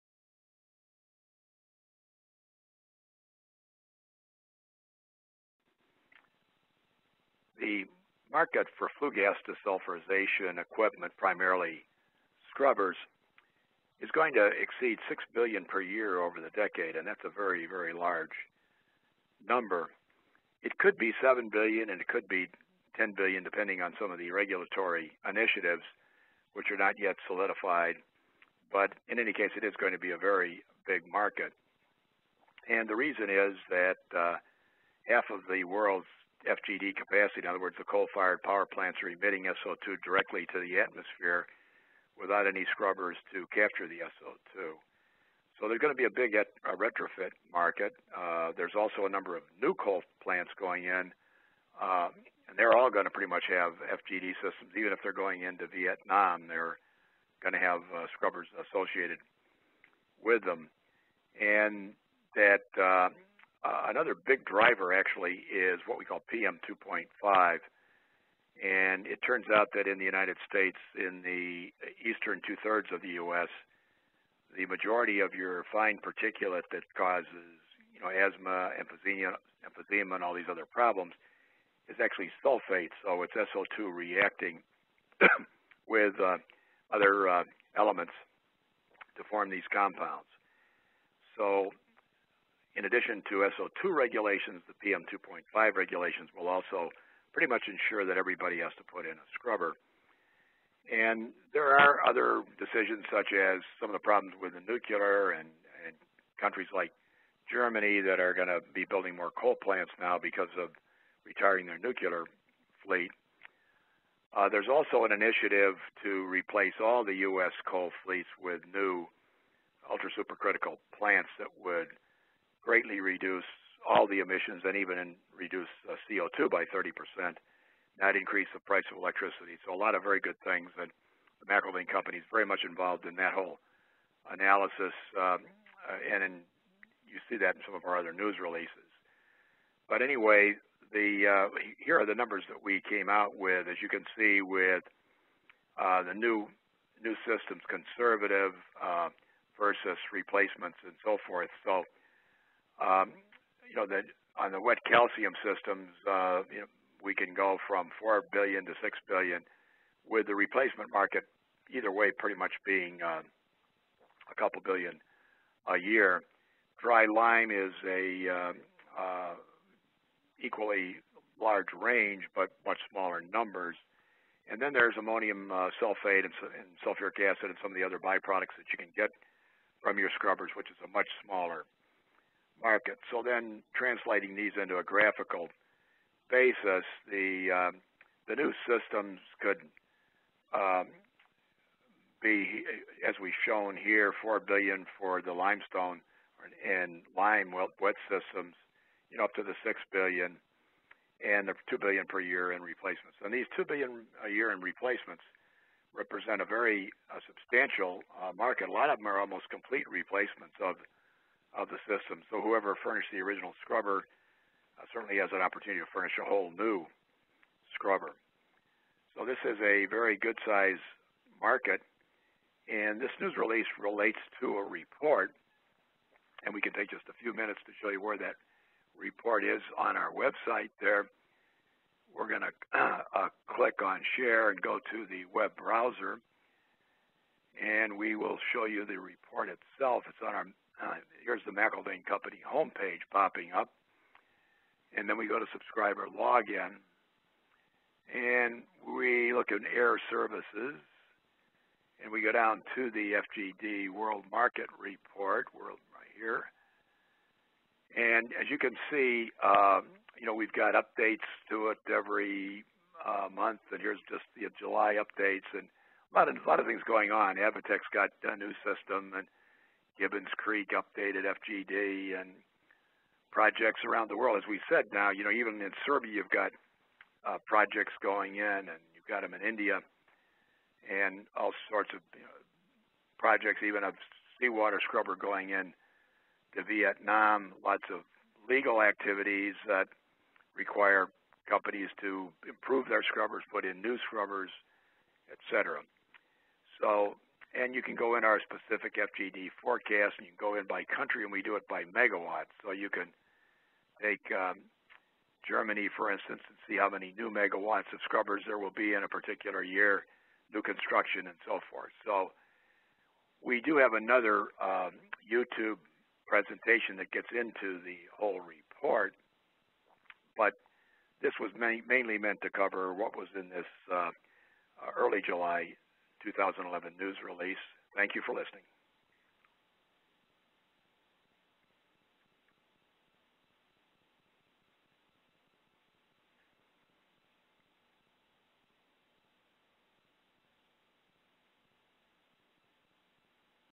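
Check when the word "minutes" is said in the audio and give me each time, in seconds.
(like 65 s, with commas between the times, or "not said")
227 s.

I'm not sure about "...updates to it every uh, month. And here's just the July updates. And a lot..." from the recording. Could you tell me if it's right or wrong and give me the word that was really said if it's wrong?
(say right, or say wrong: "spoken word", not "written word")
right.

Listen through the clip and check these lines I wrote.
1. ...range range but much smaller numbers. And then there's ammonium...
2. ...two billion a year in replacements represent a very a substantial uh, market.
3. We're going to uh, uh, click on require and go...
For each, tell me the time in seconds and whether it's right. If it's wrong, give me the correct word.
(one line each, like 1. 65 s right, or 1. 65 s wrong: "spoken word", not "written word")
1. 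171 s wrong: "large", not "range"
2. 203 s right
3. 232 s wrong: "share", not "require".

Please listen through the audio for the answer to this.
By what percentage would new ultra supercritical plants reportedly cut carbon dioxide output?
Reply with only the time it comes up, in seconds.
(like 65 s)
126 s.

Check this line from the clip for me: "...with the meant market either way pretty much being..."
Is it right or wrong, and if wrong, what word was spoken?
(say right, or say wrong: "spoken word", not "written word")
wrong: "replacement", not "meant".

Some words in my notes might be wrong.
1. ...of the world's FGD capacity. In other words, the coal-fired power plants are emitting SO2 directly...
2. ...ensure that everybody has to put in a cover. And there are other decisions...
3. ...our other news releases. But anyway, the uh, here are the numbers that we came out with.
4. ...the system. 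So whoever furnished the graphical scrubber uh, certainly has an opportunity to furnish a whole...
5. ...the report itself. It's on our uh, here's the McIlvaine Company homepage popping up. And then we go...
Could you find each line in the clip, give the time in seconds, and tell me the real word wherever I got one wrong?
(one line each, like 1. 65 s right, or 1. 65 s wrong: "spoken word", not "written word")
1. 35 s right
2. 97 s wrong: "scrubber", not "cover"
3. 137 s right
4. 211 s wrong: "original", not "graphical"
5. 238 s right.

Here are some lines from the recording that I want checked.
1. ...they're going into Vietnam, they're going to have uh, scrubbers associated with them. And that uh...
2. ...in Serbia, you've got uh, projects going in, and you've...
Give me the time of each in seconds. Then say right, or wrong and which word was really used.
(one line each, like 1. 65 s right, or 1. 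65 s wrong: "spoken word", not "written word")
1. 55 s right
2. 275 s right.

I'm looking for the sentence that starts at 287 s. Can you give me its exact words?
Lots of legal activities that require companies to improve their scrubbers, put in new scrubbers, et cetera.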